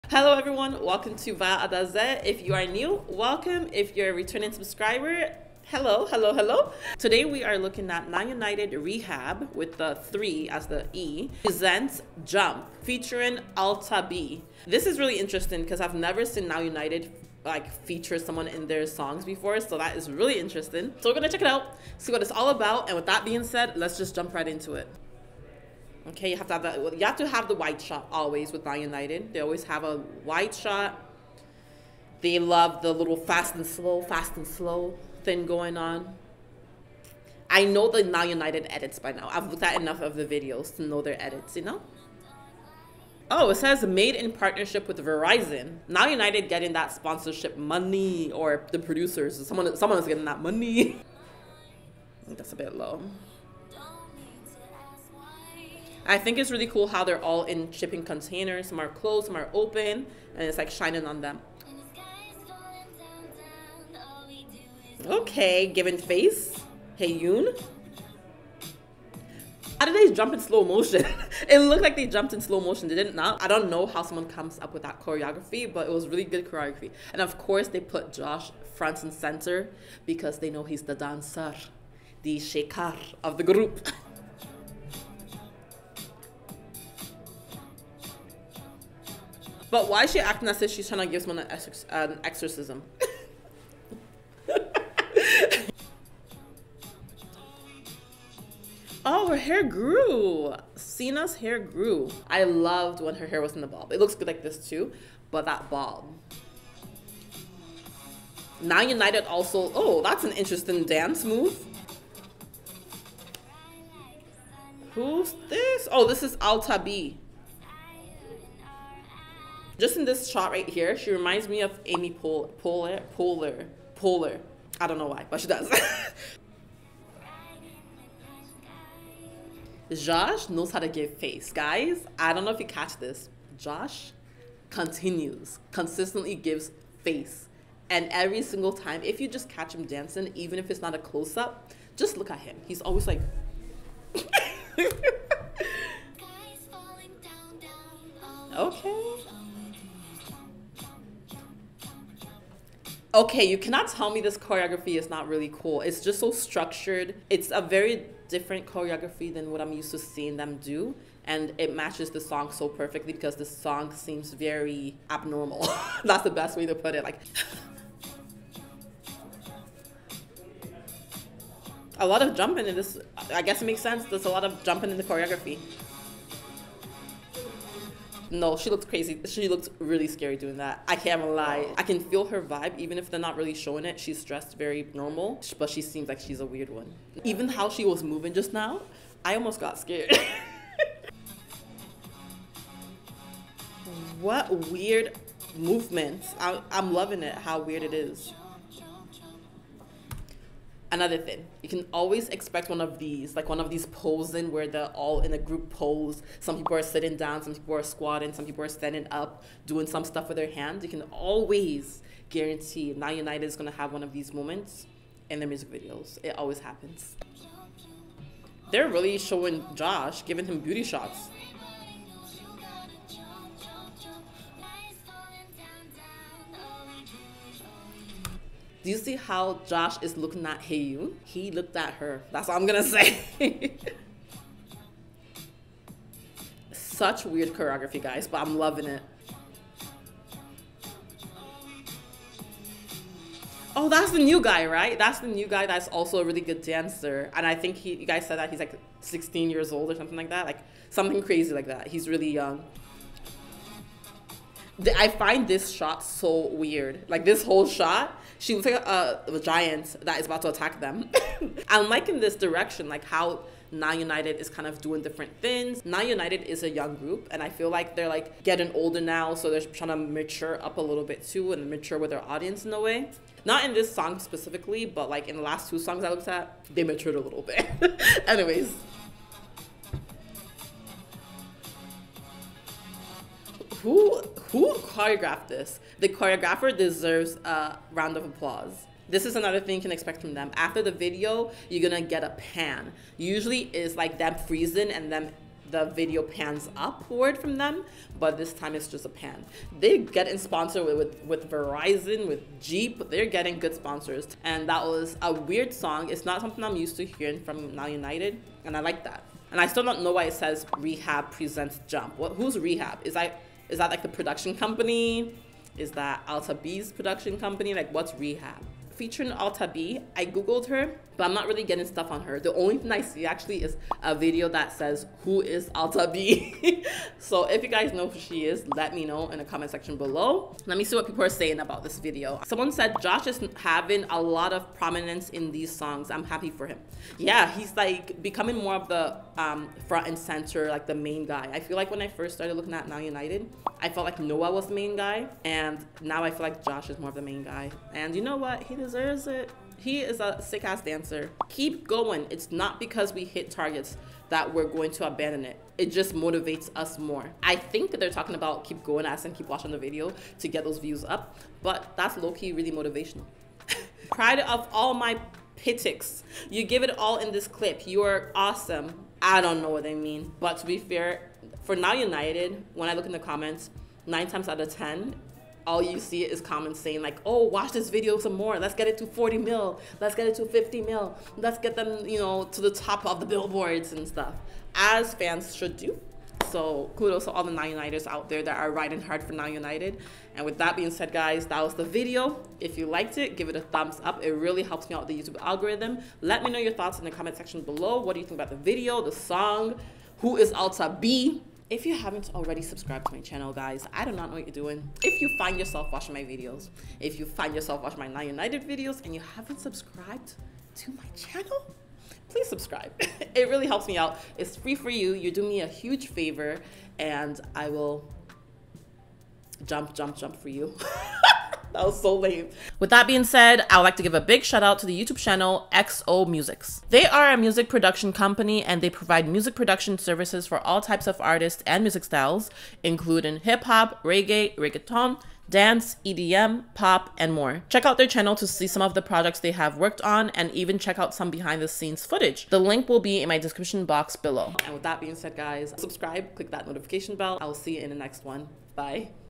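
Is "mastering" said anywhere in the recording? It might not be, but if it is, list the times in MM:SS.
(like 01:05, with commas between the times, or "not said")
not said.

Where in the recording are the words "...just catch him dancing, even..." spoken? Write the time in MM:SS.
02:19.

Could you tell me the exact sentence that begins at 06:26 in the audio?
So kudos to all the Now Uniteds out there that are riding hard for Now United.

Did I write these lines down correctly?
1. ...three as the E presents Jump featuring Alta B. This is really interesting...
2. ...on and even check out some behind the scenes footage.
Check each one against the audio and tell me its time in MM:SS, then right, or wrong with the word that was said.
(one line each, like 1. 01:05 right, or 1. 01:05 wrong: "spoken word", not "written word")
1. 00:09 right
2. 07:20 right.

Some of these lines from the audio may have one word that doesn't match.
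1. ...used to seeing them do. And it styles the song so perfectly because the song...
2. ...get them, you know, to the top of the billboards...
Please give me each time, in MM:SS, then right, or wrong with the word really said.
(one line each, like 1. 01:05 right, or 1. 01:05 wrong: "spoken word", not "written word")
1. 02:39 wrong: "matches", not "styles"
2. 06:21 right.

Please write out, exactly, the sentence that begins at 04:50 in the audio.
After the video, you're gonna get a pan.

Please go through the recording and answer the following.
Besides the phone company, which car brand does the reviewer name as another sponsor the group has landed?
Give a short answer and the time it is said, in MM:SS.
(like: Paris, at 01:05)
Jeep, at 05:02.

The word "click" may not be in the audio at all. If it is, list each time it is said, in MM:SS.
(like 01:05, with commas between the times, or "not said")
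07:26.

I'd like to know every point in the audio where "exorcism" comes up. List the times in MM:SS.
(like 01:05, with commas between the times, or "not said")
01:32.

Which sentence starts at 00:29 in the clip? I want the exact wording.
They always have a white shot.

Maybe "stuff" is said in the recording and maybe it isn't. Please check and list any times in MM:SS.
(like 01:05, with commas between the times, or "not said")
03:30, 05:21, 06:24.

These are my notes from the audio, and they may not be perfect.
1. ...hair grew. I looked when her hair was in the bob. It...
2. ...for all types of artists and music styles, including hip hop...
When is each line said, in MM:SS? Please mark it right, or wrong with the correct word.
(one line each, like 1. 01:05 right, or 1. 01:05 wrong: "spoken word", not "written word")
1. 01:41 wrong: "loved", not "looked"
2. 07:10 right.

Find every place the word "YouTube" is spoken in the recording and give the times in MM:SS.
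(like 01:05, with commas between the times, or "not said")
06:35, 07:05.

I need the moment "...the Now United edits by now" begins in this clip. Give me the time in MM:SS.
00:37.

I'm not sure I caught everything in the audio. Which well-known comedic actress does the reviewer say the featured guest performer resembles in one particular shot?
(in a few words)
Amy Poehler.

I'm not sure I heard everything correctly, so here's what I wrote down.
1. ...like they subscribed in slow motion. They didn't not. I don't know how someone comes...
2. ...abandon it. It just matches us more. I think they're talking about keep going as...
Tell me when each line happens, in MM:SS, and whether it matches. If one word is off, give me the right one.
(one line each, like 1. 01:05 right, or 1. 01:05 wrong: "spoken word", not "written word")
1. 01:11 wrong: "jumped", not "subscribed"
2. 05:55 wrong: "motivates", not "matches".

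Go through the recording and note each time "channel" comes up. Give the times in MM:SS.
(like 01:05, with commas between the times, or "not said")
06:43, 06:51, 07:05, 07:18.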